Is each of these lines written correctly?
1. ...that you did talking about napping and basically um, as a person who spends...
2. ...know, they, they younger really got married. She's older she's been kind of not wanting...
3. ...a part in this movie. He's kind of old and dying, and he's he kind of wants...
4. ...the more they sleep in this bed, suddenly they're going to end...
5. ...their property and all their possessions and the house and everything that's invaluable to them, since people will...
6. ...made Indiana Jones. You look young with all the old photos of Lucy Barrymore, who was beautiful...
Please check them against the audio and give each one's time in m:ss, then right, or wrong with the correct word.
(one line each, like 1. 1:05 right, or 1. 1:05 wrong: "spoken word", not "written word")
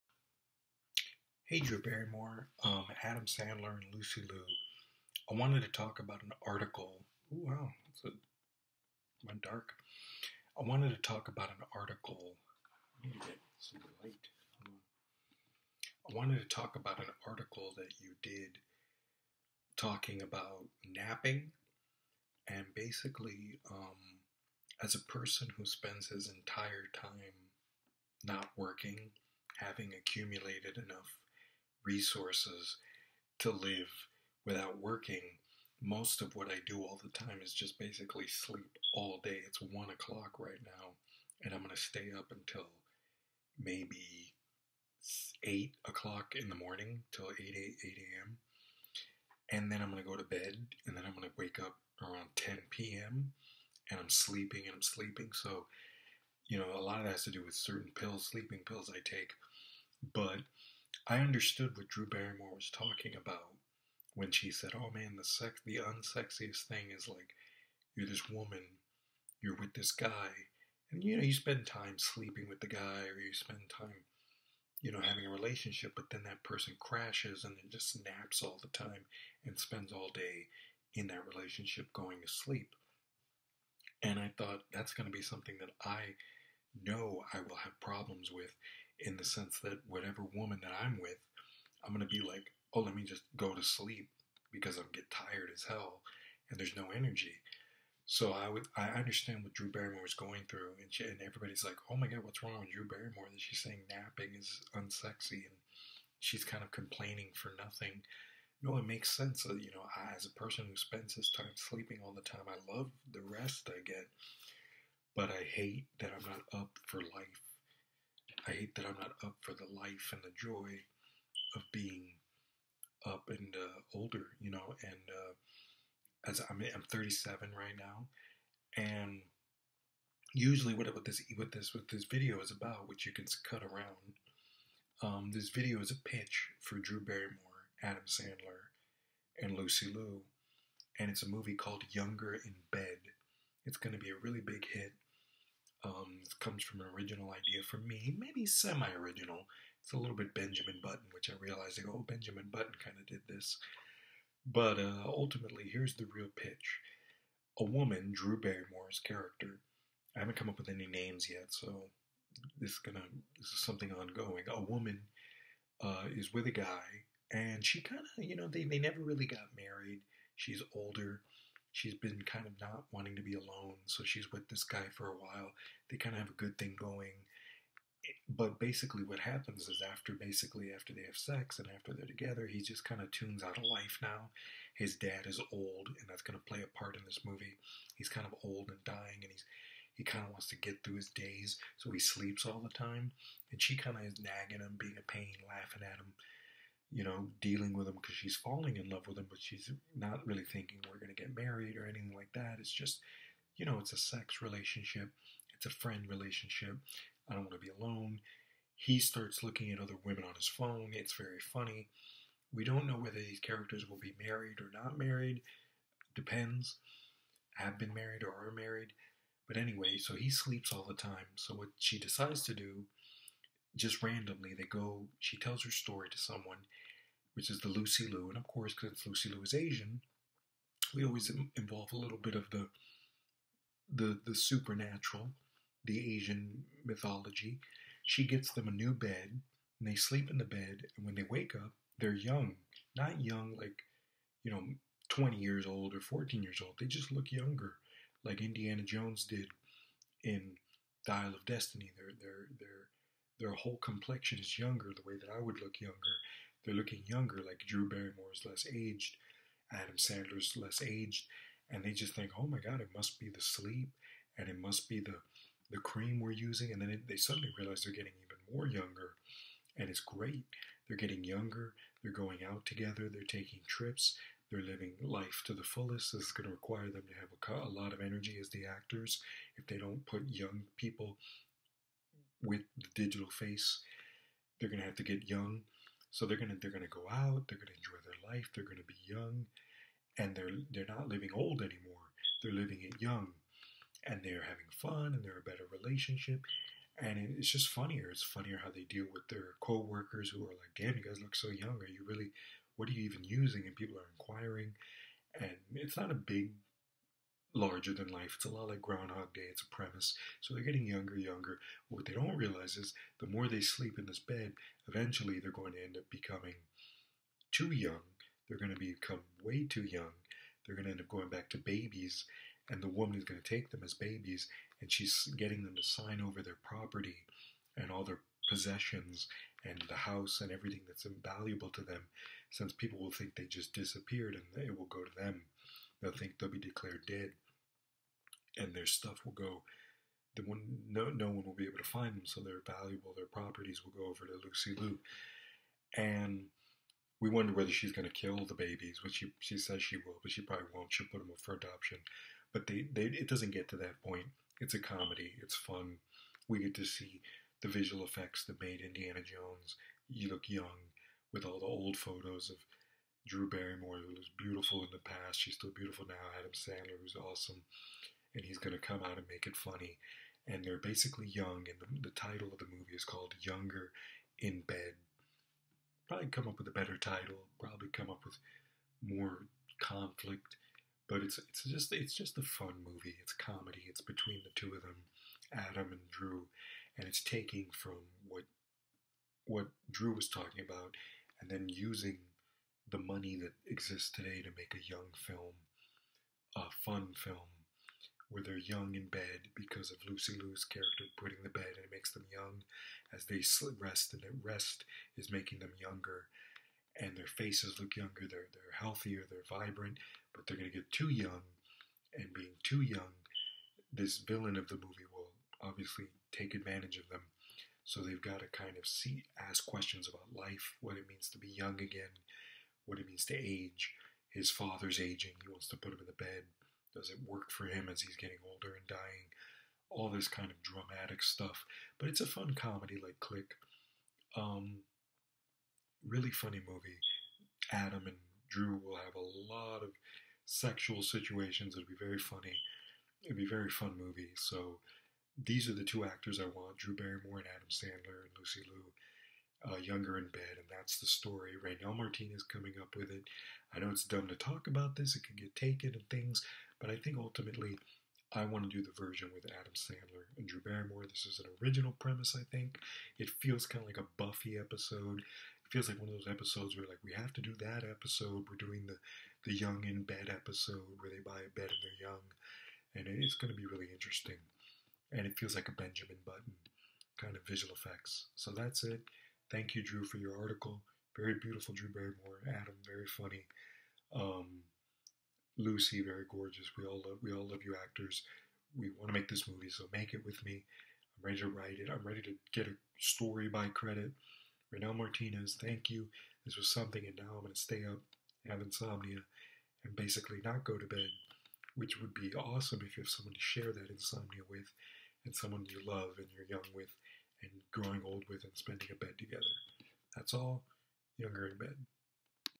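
1. 0:17 right
2. 2:48 wrong: "never", not "younger"
3. 3:06 right
4. 5:13 wrong: "eventually", not "suddenly"
5. 5:26 right
6. 5:58 wrong: "Drew", not "Lucy".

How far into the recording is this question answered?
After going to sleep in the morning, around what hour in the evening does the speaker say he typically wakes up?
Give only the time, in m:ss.
0:52.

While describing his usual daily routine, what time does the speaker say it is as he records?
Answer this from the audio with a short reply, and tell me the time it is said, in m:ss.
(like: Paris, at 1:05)
1 o'clock, at 0:39.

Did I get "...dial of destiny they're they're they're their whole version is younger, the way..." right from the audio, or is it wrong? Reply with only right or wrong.
wrong.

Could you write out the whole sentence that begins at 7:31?
Reynel Martinez coming up with it.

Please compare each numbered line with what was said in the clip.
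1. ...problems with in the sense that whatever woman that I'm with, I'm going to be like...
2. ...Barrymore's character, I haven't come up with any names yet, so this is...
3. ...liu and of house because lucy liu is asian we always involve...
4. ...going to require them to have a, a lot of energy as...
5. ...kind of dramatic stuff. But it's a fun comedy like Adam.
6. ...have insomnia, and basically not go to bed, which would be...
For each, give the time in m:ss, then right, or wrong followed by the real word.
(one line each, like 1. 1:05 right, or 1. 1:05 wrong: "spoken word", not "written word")
1. 1:27 right
2. 2:38 right
3. 3:48 wrong: "course", not "house"
4. 4:36 right
5. 7:10 wrong: "Click", not "Adam"
6. 8:18 right.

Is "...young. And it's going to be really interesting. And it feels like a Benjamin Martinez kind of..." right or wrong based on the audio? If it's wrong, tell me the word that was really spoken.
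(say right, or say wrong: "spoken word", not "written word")
wrong: "Button", not "Martinez".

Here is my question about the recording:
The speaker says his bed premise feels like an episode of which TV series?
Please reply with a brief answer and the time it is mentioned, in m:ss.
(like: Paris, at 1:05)
Buffy, at 7:44.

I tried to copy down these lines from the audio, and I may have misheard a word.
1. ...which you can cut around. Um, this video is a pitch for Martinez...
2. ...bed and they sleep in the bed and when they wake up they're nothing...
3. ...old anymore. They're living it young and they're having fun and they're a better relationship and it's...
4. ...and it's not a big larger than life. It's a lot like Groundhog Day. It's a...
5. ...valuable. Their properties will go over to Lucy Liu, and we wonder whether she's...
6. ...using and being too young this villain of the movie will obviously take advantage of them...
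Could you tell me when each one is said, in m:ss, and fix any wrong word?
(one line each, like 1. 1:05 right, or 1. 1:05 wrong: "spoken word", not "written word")
1. 2:12 wrong: "Drew", not "Martinez"
2. 3:58 wrong: "young", not "nothing"
3. 4:51 right
4. 5:05 right
5. 5:42 right
6. 6:51 wrong: "young", not "using".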